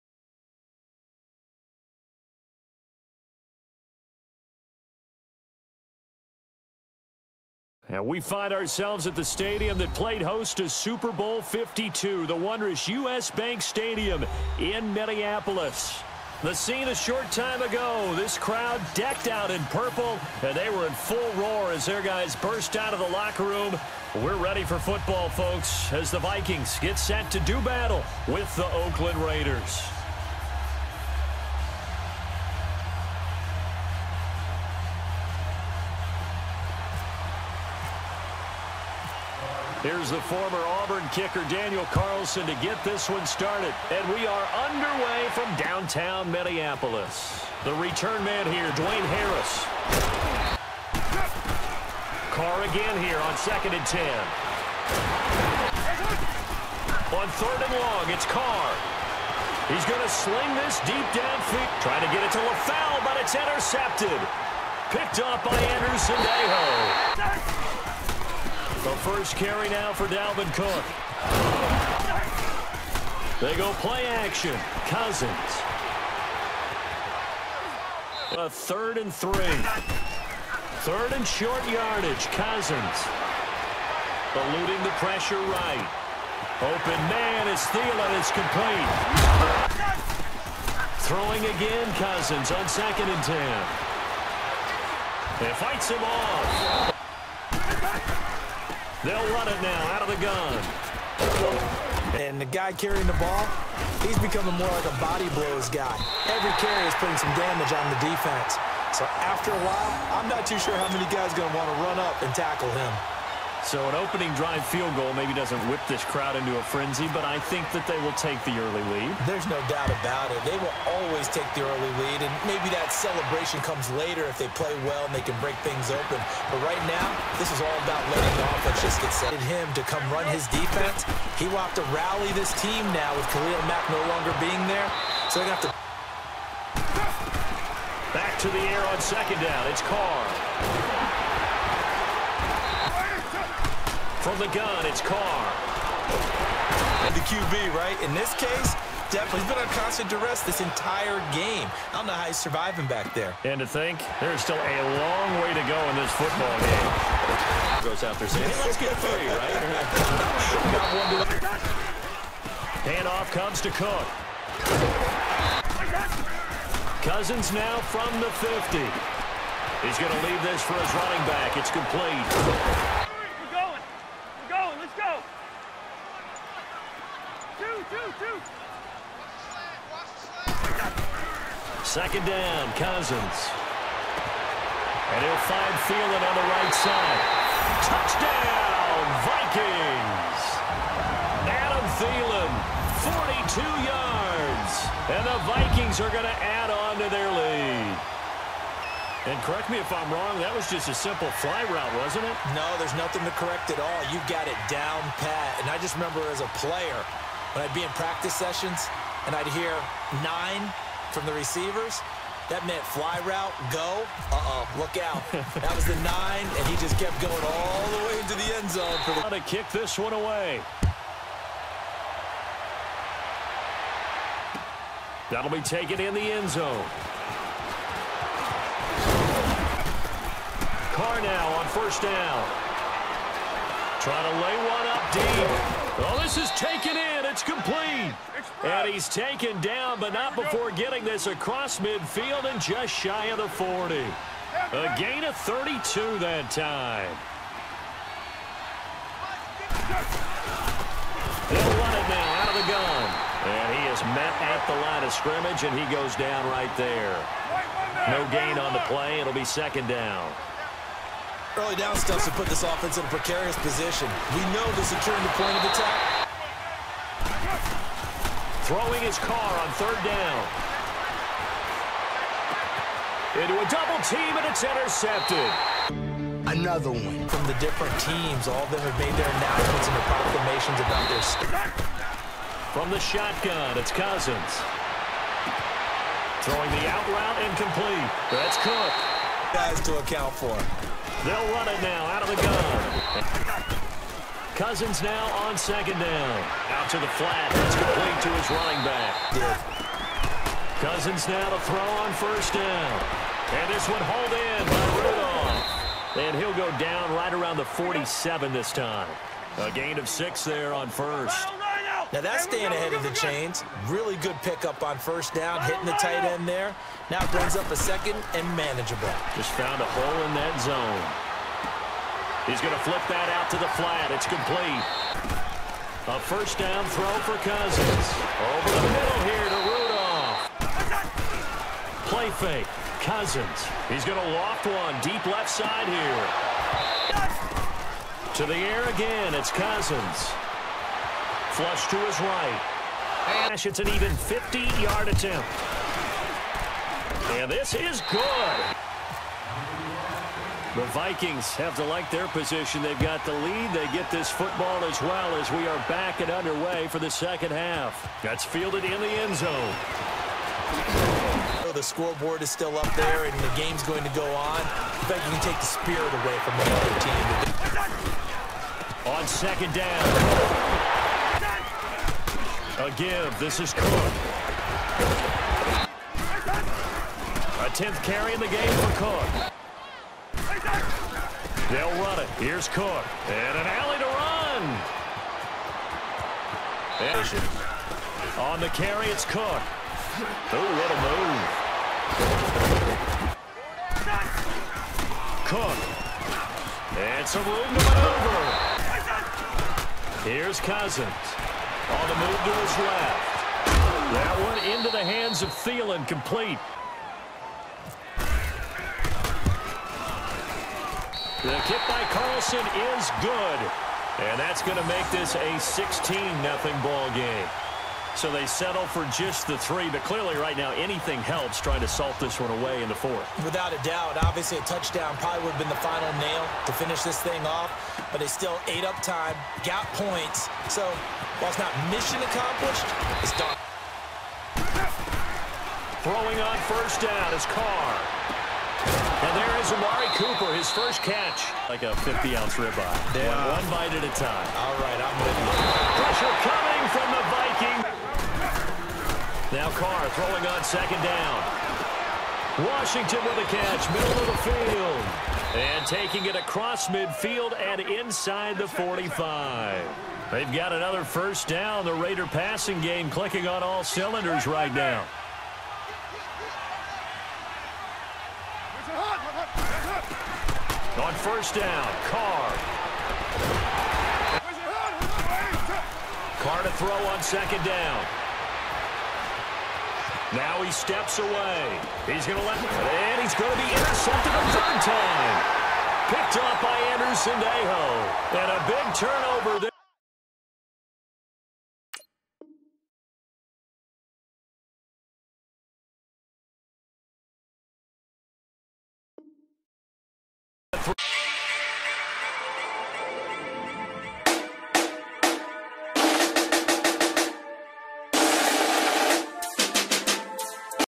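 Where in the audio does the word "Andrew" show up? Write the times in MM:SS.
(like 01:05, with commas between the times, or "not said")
01:05, 08:06.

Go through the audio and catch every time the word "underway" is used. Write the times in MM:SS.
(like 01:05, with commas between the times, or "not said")
00:44, 05:56.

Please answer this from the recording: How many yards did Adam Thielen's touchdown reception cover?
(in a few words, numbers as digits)
42.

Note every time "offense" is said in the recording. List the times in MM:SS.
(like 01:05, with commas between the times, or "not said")
02:08, 04:22.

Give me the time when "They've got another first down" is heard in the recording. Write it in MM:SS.
07:40.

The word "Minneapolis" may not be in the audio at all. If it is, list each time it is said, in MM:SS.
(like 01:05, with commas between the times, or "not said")
00:14, 00:46.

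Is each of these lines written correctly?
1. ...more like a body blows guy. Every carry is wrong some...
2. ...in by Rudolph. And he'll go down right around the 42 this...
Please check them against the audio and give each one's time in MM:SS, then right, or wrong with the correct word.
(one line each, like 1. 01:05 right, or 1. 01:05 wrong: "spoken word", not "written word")
1. 01:44 wrong: "putting", not "wrong"
2. 05:04 wrong: "47", not "42".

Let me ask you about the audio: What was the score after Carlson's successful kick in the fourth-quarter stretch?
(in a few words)
16-0.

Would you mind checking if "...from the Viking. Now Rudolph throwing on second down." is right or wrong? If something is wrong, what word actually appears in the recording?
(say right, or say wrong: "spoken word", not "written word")
wrong: "Carr", not "Rudolph".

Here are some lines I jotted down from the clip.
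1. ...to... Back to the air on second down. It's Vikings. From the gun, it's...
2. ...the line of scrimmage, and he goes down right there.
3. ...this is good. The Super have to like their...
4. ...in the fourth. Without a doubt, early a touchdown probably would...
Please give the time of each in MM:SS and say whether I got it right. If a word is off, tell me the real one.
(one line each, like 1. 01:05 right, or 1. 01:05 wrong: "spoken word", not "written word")
1. 02:15 wrong: "Carr", not "Vikings"
2. 04:14 right
3. 05:47 wrong: "Vikings", not "Super"
4. 07:02 wrong: "obviously", not "early".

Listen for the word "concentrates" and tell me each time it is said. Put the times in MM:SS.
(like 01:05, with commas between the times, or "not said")
not said.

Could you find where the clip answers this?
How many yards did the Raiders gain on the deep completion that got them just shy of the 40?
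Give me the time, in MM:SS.
04:05.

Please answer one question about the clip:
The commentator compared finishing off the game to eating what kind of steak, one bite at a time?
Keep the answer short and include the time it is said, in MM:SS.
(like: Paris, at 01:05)
50-ounce ribeye, at 07:22.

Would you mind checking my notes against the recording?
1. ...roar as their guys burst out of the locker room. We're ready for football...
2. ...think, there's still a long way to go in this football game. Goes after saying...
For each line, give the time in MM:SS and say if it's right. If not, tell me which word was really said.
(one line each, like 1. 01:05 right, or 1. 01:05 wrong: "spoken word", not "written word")
1. 00:21 right
2. 02:33 right.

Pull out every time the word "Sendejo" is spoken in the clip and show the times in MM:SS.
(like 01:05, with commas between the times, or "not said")
01:06, 08:07.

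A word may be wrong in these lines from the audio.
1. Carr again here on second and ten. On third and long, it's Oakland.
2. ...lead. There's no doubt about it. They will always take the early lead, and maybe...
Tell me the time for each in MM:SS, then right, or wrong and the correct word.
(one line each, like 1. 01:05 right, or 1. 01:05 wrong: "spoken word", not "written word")
1. 00:52 wrong: "Carr", not "Oakland"
2. 01:58 right.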